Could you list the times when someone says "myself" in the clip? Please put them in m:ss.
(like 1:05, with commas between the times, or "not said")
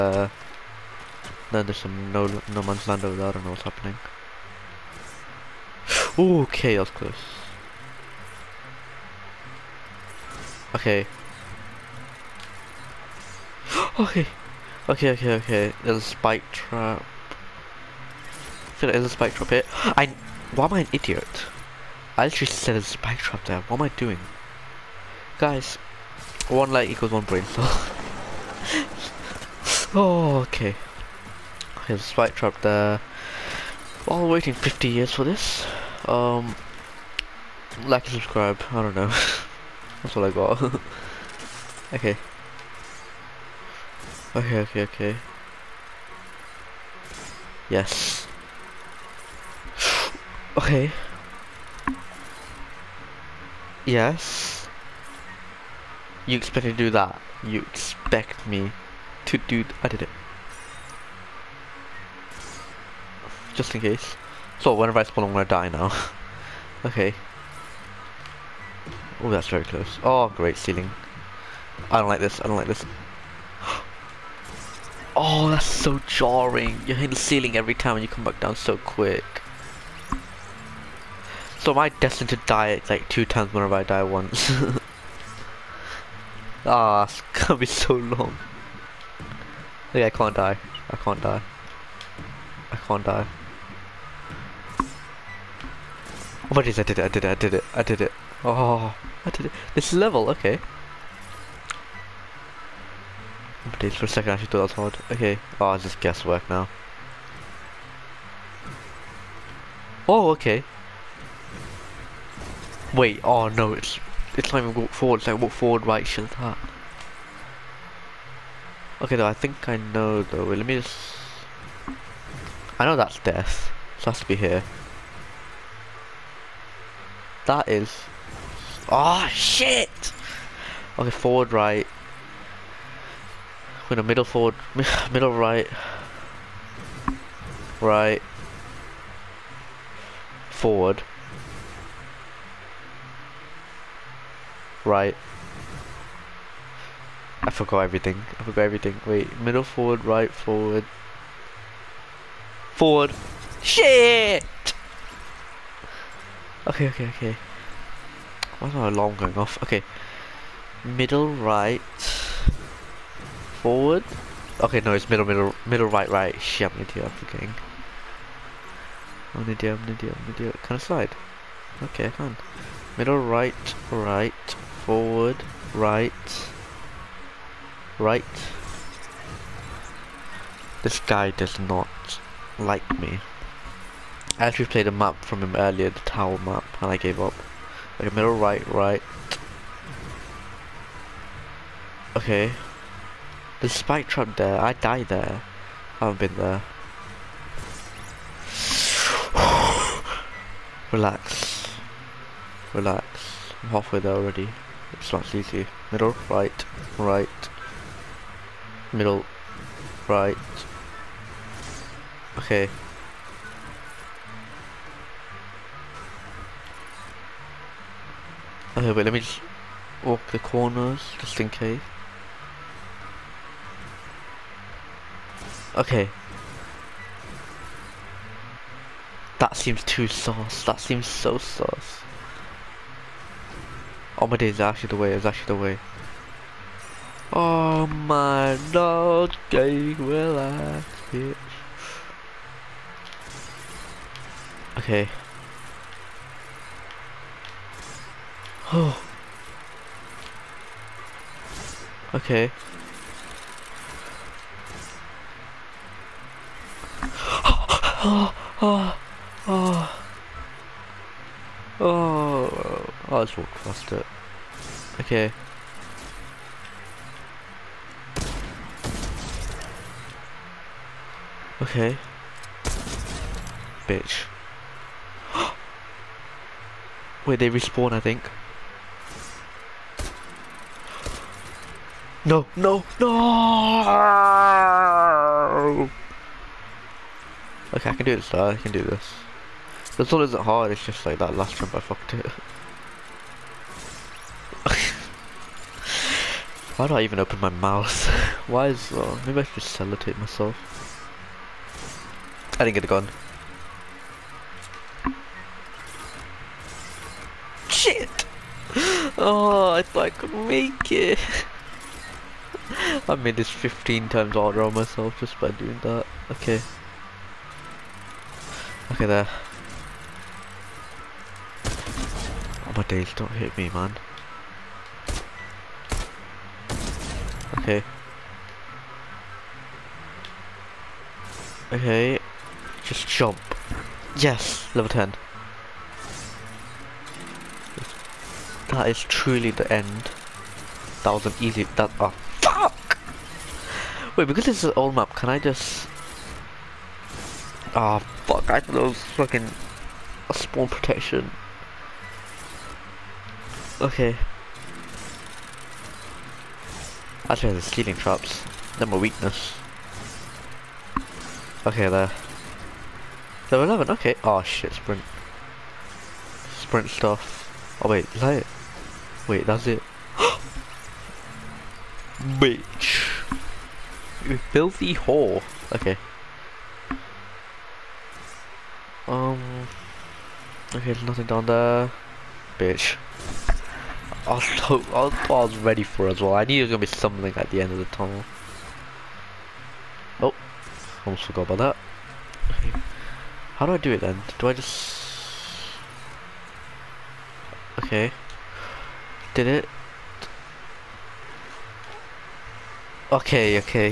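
5:00, 5:14.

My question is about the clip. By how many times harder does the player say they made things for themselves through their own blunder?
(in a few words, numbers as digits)
15.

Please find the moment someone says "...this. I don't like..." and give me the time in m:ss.
1:12.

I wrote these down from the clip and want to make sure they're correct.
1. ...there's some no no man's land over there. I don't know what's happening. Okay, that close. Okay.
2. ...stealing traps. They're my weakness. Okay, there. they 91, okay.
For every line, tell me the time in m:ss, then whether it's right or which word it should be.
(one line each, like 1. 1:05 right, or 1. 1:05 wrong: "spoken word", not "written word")
1. 0:01 right
2. 5:57 wrong: "11", not "91".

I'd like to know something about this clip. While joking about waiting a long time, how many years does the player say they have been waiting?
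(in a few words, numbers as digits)
50.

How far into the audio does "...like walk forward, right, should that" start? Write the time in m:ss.
1:55.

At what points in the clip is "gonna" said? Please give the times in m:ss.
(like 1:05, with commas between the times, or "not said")
1:05, 1:27, 6:26.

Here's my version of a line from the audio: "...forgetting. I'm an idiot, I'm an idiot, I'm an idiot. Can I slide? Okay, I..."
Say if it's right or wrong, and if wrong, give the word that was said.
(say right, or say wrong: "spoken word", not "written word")
right.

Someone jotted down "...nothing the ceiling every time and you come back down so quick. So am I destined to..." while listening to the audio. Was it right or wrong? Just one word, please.
wrong.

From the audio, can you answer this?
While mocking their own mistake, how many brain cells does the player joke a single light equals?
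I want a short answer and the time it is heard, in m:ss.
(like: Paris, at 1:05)
1 brain cell, at 0:27.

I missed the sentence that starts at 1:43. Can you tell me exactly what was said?
Oh for a second I should thought that hard.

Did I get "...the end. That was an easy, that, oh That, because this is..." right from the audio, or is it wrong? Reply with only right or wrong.
wrong.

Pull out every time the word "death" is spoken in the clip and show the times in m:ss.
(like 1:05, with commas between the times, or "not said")
2:03.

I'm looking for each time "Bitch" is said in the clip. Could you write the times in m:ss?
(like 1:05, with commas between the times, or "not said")
4:01, 4:33, 6:12, 6:22.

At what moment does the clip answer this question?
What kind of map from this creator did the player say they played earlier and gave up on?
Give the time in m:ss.
3:05.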